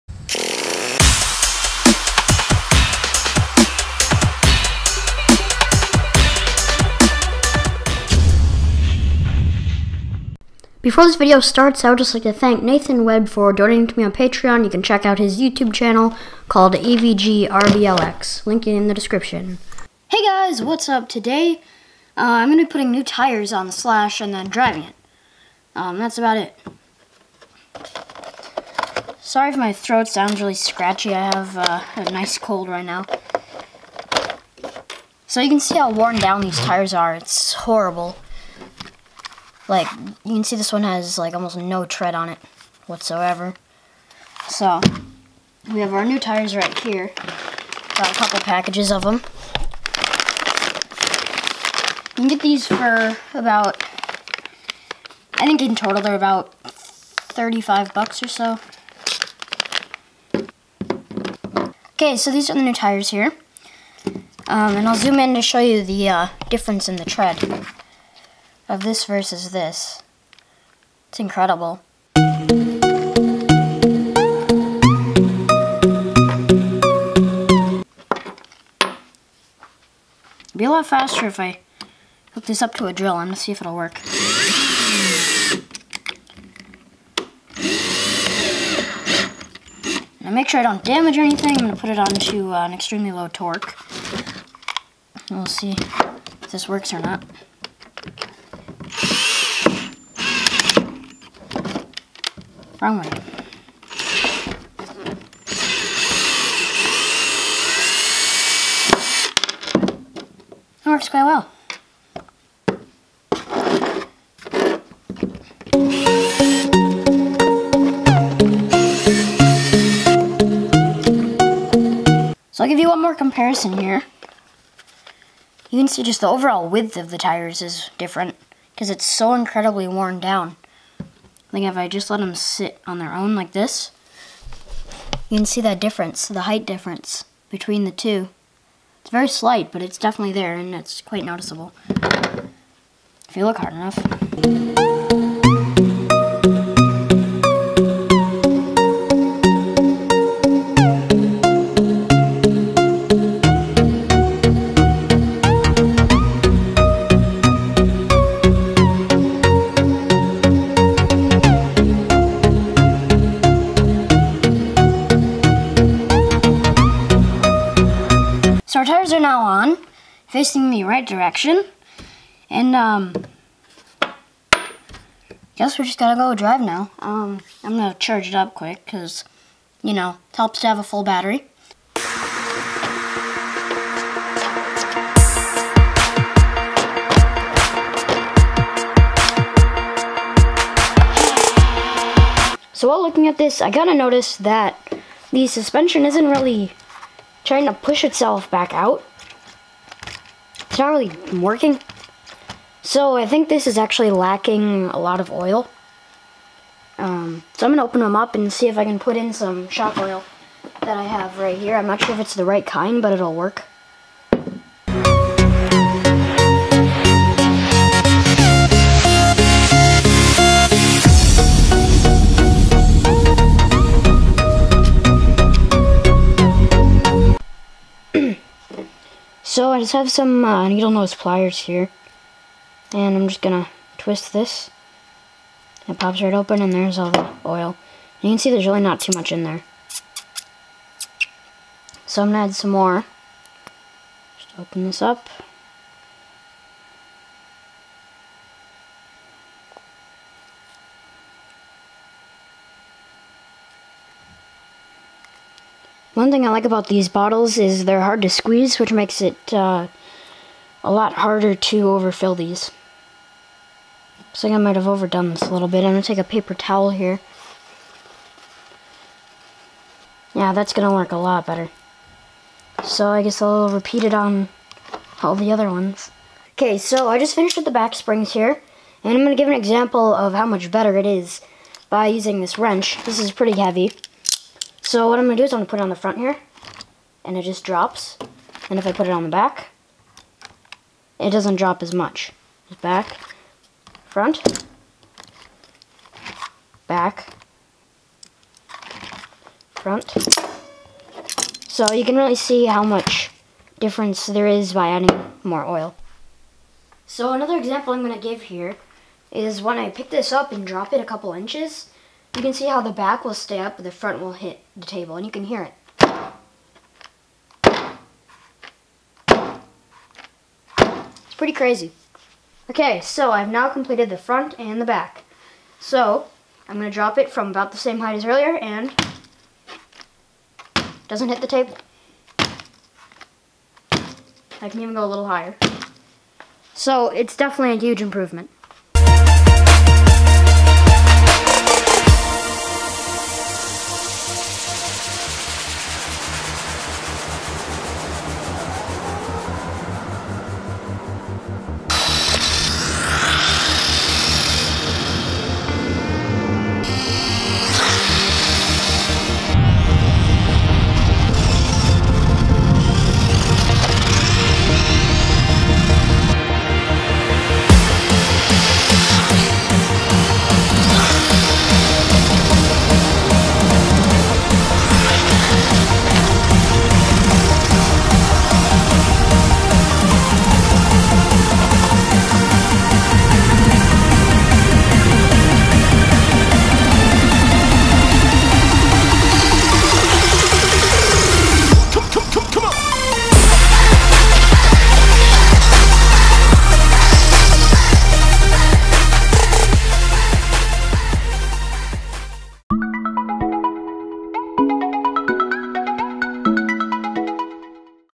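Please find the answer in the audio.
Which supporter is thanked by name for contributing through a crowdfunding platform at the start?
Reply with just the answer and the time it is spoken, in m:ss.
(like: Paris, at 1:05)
Nathan Webb, at 0:12.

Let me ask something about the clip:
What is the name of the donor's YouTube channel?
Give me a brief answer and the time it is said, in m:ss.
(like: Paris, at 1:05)
AVGRBLX, at 0:16.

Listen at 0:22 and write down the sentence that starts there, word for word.
Uh, I'm going to be putting new tires on the Slash and then driving it.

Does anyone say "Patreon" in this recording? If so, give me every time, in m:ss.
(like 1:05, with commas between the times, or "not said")
0:14.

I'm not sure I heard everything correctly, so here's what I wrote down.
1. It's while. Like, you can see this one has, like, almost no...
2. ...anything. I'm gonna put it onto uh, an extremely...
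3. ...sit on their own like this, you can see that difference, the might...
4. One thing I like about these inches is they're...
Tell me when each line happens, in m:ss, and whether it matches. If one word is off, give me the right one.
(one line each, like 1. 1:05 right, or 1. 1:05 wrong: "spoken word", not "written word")
1. 0:37 wrong: "horrible", not "while"
2. 1:31 right
3. 2:12 wrong: "height", not "might"
4. 4:16 wrong: "bottles", not "inches".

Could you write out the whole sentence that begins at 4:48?
And if I put it on the back, it doesn't drop as much.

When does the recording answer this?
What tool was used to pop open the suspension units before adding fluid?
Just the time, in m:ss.
3:50.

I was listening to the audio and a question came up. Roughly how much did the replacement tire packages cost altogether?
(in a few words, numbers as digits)
$35.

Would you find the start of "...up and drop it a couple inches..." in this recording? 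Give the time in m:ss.
5:10.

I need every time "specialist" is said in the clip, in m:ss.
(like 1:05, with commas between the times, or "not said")
not said.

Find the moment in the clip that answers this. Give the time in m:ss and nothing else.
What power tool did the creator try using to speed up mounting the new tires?
1:22.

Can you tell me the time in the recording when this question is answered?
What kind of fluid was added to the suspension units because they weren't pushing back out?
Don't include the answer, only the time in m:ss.
3:29.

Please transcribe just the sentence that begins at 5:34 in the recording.
I can even go a little higher.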